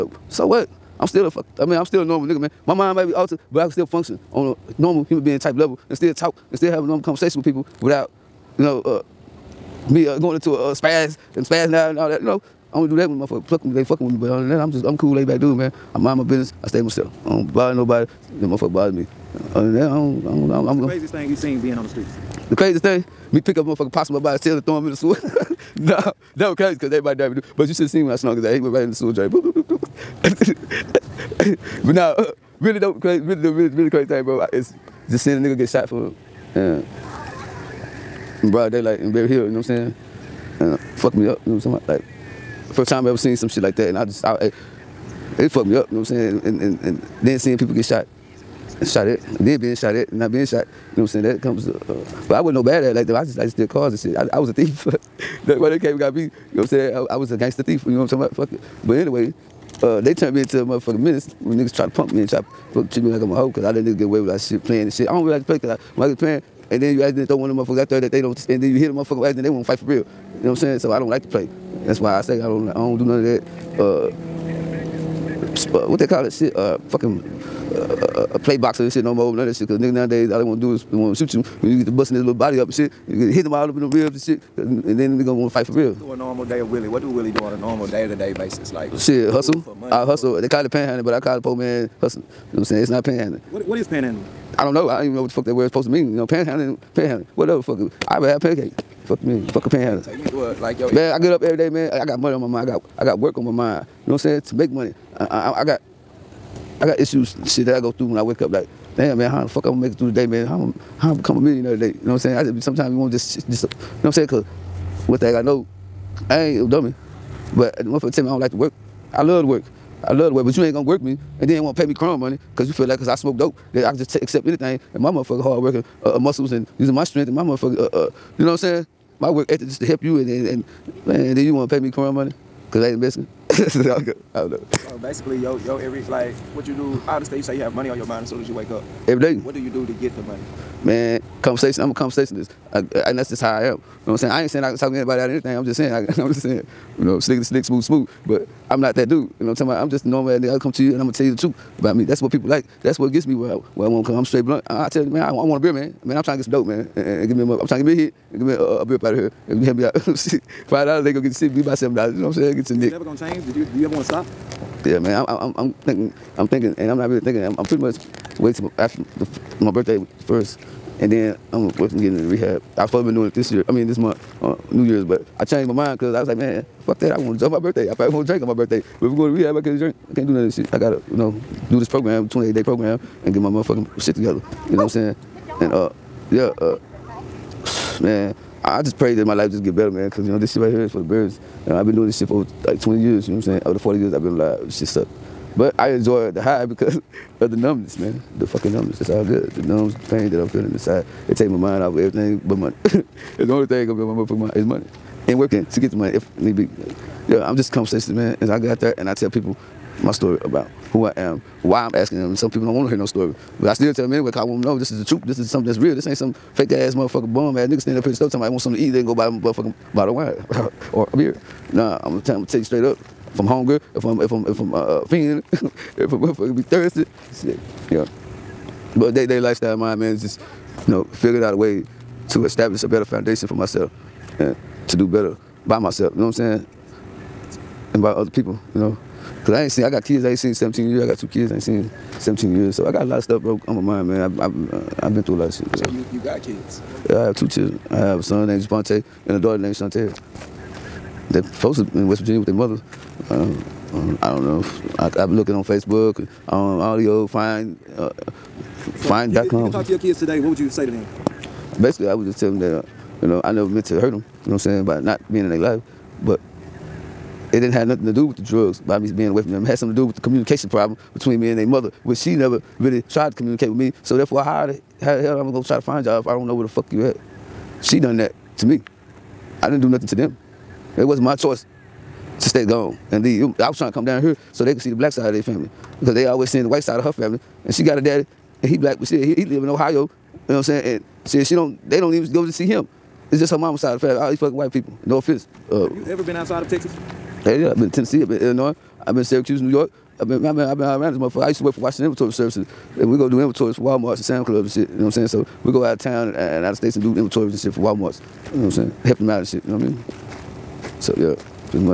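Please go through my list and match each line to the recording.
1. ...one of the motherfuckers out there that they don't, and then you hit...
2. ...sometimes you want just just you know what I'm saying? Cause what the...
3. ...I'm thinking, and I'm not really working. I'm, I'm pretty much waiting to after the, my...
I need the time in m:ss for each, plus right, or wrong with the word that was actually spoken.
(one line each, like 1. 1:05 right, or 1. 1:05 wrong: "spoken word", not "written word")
1. 1:07 right
2. 1:52 right
3. 2:46 wrong: "thinking", not "working".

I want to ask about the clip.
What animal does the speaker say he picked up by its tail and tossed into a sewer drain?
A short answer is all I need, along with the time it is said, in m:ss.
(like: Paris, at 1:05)
Possum, at 0:23.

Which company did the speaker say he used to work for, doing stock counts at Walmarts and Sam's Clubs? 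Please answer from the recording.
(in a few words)
Washington Inventory Services.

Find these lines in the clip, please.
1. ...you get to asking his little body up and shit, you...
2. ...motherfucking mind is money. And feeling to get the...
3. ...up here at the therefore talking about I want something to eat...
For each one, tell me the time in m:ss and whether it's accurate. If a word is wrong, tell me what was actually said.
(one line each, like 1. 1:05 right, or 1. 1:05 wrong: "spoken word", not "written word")
1. 1:21 wrong: "busting", not "asking"
2. 3:24 wrong: "working", not "feeling"
3. 3:37 wrong: "store", not "therefore".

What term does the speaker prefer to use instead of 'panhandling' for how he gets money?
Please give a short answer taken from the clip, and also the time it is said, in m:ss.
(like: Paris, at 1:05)
Poor man hustling, at 1:31.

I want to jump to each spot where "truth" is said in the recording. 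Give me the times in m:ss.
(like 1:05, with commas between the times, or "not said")
2:31, 3:35.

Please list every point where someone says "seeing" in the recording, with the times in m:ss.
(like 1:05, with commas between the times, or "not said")
0:35, 0:47, 4:46.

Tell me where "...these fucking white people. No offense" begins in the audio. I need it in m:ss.
4:54.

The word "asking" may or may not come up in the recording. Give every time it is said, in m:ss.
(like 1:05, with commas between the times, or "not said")
3:31.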